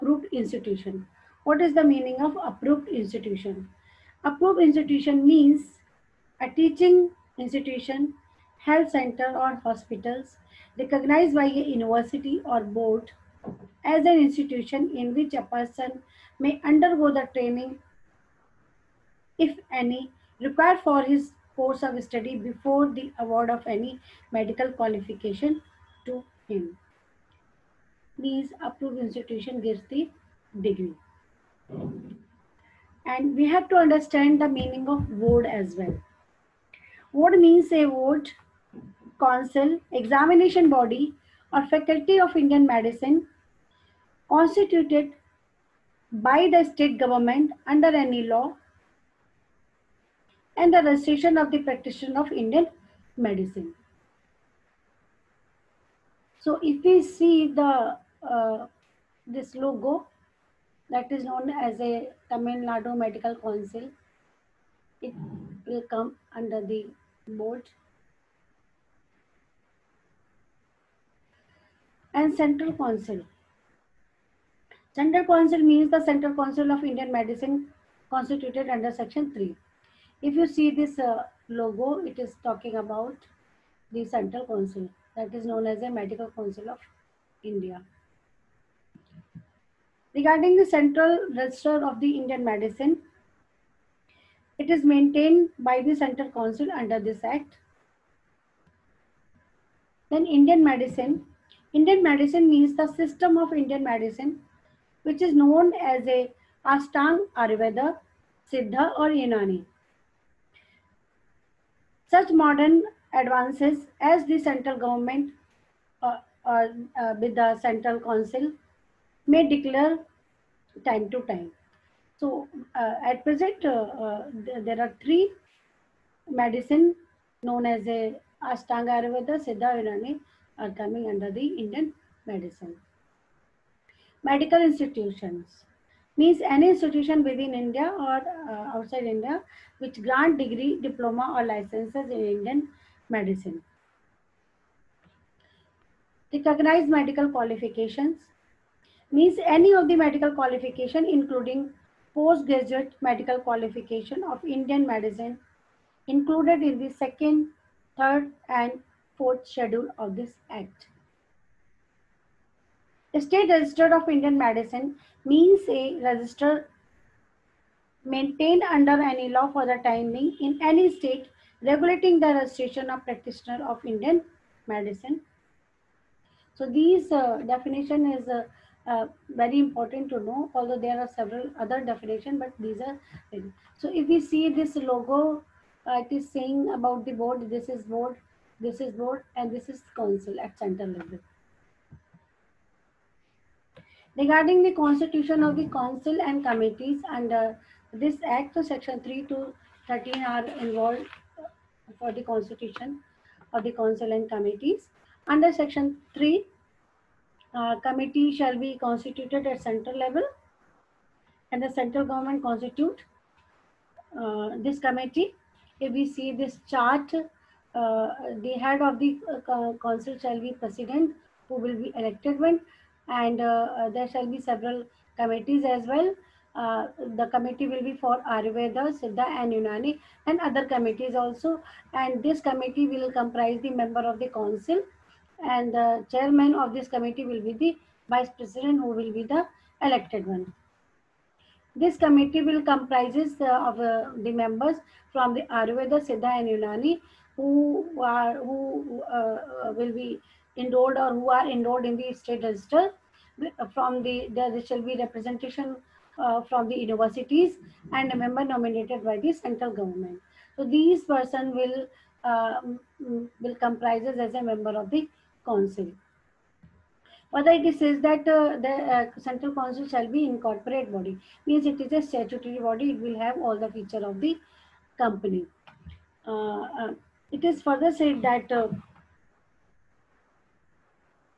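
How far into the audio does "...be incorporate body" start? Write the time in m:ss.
4:30.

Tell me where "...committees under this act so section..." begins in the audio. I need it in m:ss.
3:16.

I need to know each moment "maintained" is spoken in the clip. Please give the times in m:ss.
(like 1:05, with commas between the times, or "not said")
1:34, 2:48.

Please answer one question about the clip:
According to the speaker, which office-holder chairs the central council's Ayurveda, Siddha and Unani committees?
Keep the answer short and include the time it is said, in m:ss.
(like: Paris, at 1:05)
Vice president, at 3:58.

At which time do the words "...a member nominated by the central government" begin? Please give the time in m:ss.
4:18.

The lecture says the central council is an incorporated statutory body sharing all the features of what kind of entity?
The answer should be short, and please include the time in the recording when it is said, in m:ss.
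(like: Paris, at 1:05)
Company, at 4:34.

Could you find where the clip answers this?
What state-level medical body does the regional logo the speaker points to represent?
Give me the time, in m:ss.
1:02.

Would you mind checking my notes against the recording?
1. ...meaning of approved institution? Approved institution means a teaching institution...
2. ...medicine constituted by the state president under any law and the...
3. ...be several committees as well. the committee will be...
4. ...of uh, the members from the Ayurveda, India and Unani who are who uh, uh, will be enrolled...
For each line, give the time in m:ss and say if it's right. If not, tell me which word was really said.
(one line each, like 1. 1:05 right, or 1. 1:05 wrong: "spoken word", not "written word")
1. 0:01 right
2. 0:42 wrong: "government", not "president"
3. 3:44 right
4. 4:03 wrong: "Siddha", not "India".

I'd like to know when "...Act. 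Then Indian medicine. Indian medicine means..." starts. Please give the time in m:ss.
1:37.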